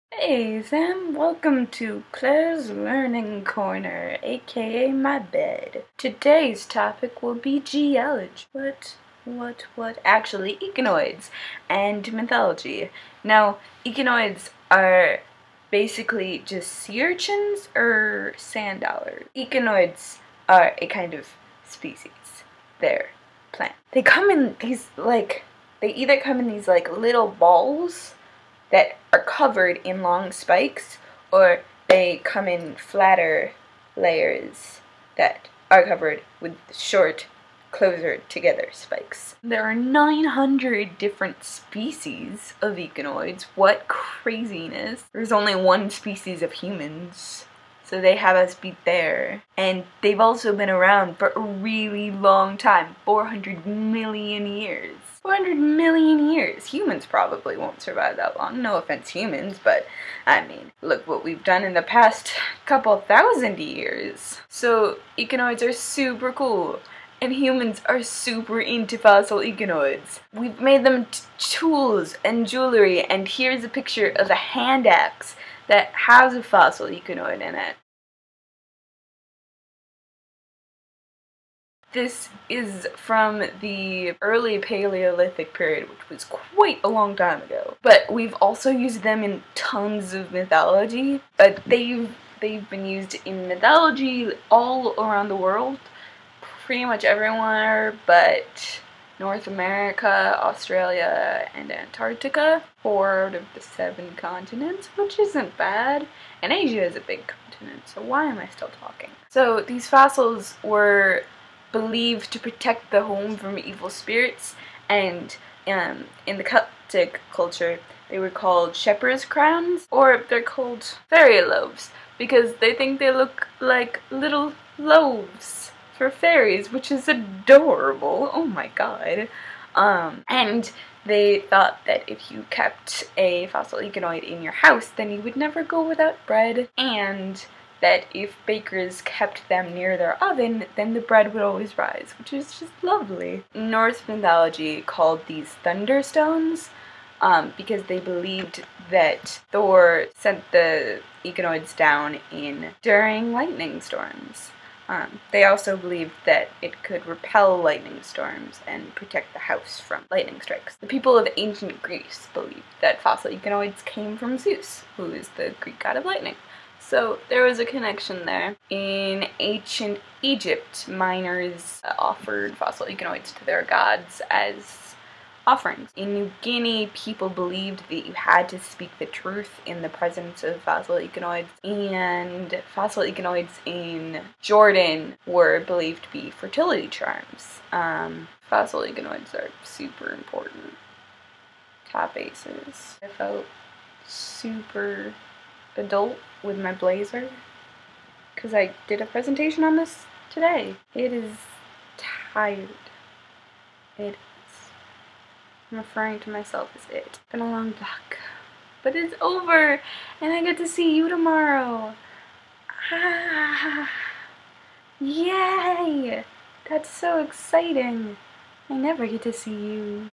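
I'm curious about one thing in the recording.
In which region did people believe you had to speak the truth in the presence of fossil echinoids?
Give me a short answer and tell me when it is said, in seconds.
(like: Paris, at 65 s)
New Guinea, at 176 s.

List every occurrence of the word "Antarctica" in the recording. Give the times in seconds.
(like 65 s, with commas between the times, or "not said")
101 s.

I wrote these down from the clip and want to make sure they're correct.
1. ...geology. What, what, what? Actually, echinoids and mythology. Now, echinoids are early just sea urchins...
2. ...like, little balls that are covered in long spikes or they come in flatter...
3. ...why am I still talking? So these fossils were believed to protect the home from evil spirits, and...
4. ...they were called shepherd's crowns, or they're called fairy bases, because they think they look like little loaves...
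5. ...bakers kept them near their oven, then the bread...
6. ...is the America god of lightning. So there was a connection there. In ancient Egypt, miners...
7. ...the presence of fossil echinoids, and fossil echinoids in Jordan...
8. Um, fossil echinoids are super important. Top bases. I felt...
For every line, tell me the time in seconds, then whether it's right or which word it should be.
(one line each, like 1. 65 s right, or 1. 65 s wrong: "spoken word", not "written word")
1. 7 s wrong: "basically", not "early"
2. 26 s right
3. 108 s right
4. 118 s wrong: "loaves", not "bases"
5. 138 s right
6. 165 s wrong: "Greek", not "America"
7. 179 s right
8. 187 s right.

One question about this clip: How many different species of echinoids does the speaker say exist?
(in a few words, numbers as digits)
900.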